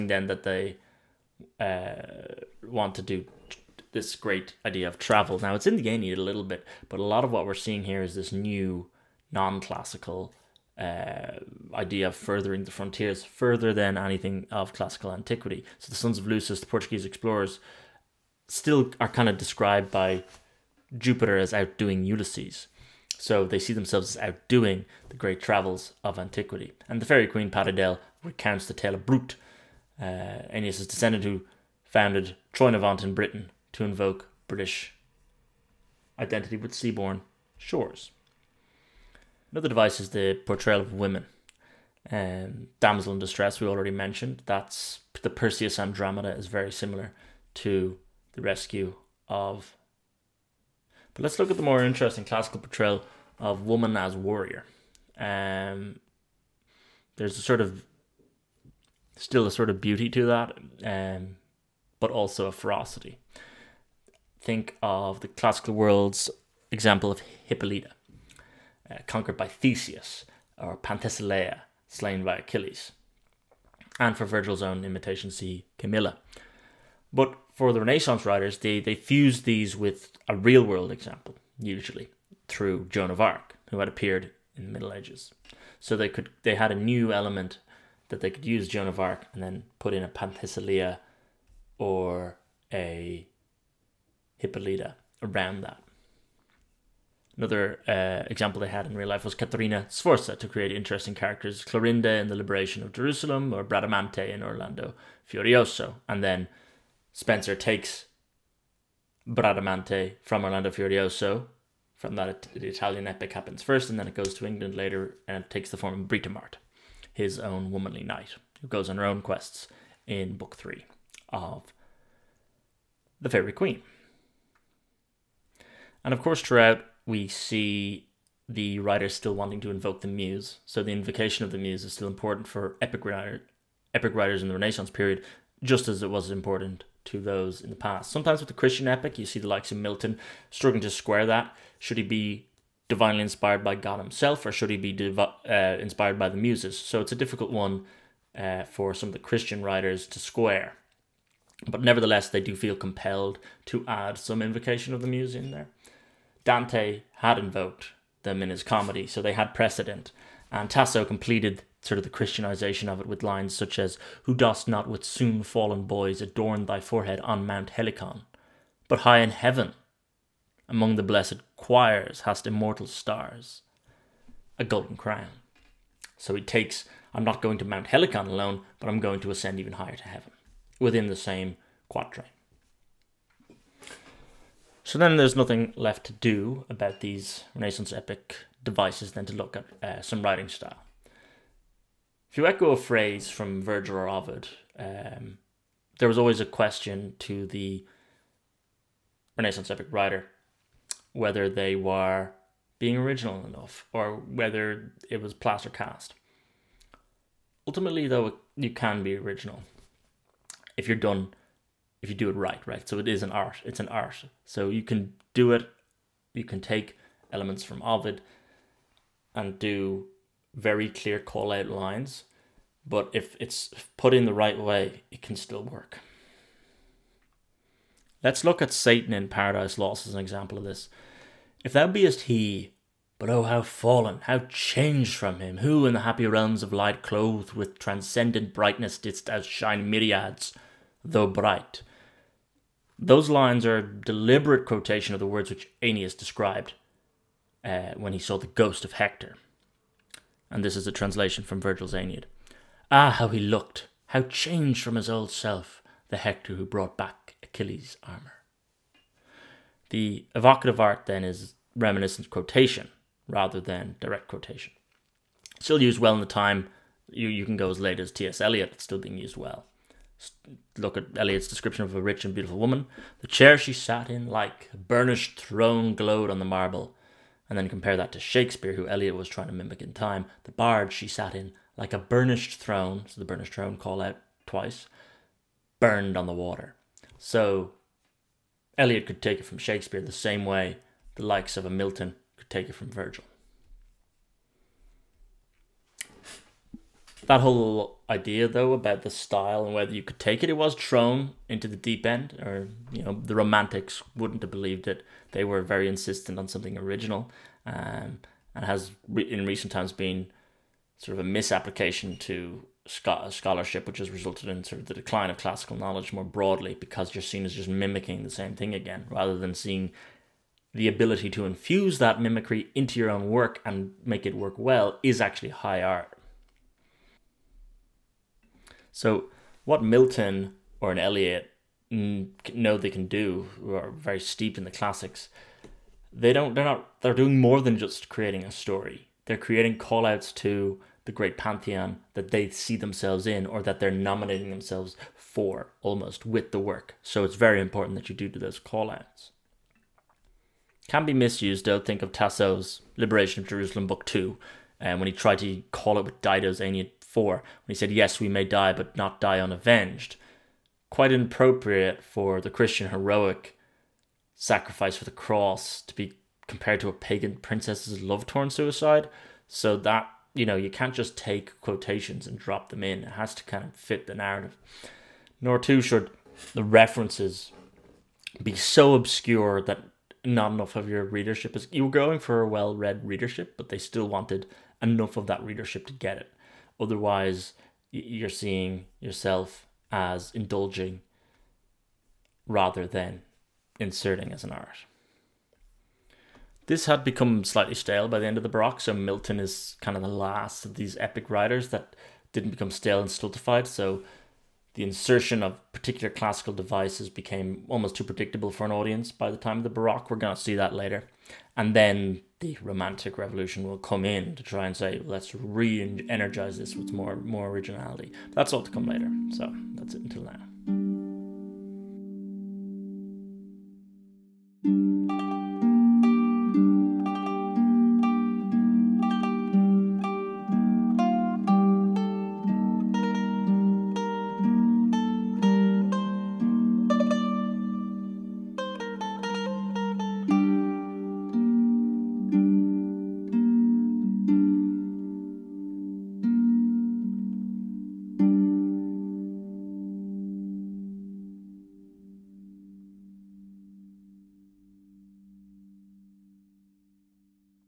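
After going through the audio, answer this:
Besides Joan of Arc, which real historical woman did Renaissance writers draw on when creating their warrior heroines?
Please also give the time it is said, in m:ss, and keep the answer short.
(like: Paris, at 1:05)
Caterina Sforza, at 1:39.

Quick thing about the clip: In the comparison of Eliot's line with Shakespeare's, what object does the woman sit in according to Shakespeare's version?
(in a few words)
The barge.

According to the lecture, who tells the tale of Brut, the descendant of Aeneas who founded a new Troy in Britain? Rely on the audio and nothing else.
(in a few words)
Paridel.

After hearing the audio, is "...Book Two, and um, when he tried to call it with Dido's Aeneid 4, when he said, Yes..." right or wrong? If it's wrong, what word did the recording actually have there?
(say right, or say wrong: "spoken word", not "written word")
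right.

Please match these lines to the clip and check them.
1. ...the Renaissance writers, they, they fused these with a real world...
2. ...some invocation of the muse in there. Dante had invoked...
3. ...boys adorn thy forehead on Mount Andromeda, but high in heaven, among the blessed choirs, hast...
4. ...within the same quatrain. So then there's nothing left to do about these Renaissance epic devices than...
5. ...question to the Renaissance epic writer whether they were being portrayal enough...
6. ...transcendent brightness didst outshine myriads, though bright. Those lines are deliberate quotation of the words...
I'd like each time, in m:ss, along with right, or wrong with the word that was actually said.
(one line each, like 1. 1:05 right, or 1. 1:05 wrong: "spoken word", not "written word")
1. 1:17 right
2. 2:34 right
3. 2:45 wrong: "Helicon", not "Andromeda"
4. 3:00 right
5. 3:16 wrong: "original", not "portrayal"
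6. 3:57 right.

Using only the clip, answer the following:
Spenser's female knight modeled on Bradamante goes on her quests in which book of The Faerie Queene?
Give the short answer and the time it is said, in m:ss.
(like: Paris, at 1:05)
Book 3, at 2:00.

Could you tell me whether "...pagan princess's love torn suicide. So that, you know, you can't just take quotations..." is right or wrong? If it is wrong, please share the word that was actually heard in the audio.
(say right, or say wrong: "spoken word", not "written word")
right.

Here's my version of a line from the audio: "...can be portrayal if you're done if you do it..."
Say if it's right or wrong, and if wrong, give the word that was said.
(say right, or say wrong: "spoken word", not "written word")
wrong: "original", not "portrayal".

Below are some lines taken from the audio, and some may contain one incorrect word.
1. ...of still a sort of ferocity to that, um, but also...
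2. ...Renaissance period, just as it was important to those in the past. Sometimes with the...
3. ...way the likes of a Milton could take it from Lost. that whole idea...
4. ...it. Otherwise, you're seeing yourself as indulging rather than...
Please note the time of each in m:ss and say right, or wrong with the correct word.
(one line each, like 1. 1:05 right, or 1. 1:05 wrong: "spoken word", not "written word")
1. 0:57 wrong: "beauty", not "ferocity"
2. 2:14 right
3. 4:50 wrong: "Virgil", not "Lost"
4. 6:26 right.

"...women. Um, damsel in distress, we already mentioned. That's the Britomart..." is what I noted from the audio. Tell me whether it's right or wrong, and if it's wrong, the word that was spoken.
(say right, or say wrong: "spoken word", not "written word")
wrong: "Perseus", not "Britomart".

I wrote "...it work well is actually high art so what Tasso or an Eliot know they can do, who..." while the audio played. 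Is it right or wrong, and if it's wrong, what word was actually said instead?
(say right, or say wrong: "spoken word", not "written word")
wrong: "Milton", not "Tasso".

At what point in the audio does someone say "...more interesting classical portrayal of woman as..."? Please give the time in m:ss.
0:51.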